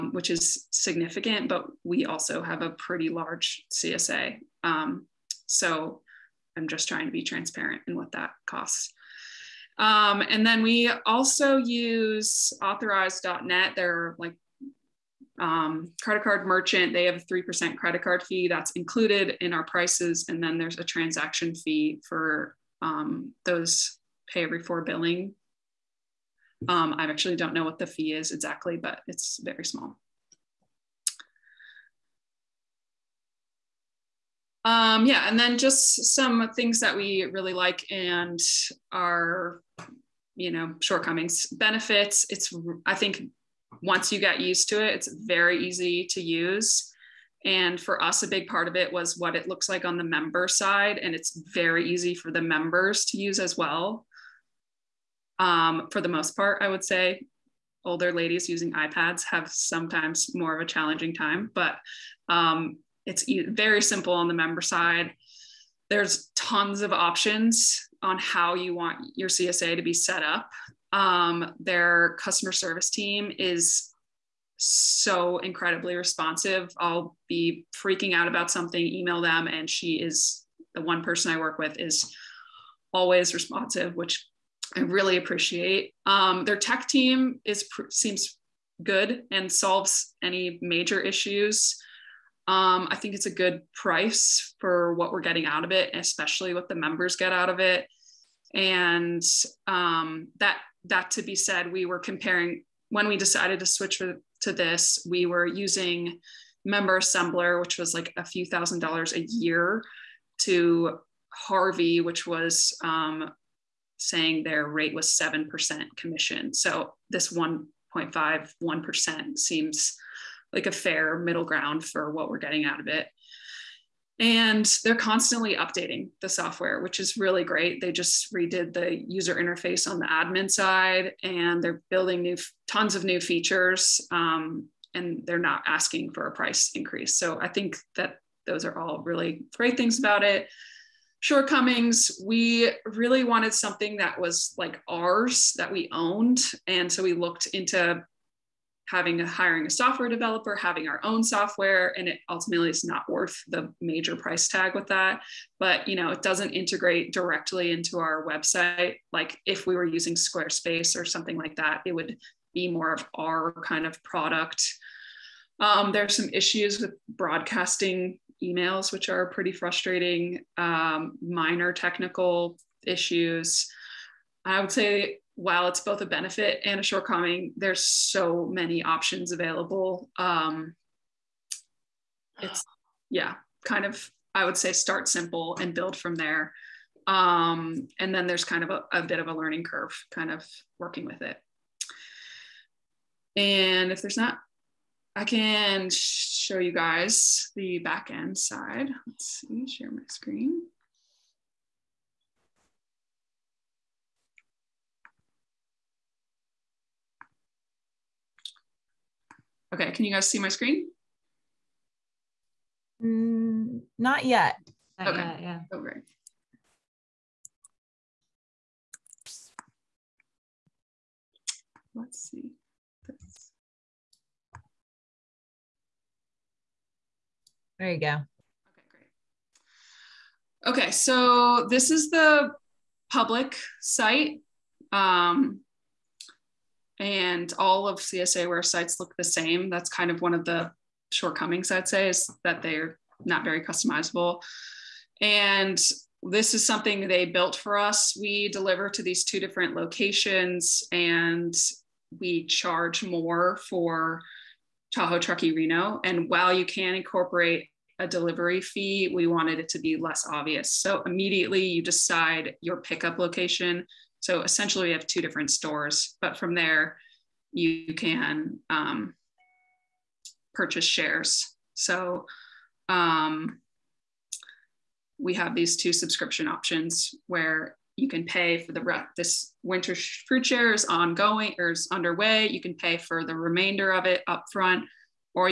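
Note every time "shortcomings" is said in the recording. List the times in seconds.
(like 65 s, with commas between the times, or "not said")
40 s, 141 s, 176 s, 241 s.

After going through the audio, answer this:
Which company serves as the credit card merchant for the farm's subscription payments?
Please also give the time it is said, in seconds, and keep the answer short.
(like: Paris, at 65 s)
Authorize.net, at 12 s.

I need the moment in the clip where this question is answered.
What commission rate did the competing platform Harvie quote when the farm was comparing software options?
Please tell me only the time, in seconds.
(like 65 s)
115 s.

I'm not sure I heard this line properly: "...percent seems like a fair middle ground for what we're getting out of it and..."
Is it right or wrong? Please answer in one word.
right.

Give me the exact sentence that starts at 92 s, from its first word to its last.
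Um, I think it's a good price for what we're getting out of it, especially what the members get out of it.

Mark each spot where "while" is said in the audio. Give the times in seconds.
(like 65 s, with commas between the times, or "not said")
175 s, 256 s.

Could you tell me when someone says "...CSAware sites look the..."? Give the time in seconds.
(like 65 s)
237 s.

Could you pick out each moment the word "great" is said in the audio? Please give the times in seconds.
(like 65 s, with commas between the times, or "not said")
127 s, 139 s, 215 s, 228 s.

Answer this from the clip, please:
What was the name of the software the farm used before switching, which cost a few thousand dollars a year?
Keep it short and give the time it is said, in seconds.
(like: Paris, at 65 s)
Member Assembler, at 106 s.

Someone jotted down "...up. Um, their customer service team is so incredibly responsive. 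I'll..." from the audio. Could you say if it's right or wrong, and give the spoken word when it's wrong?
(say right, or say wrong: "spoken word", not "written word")
right.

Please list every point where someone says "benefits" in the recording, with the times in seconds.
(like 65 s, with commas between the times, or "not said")
41 s, 176 s.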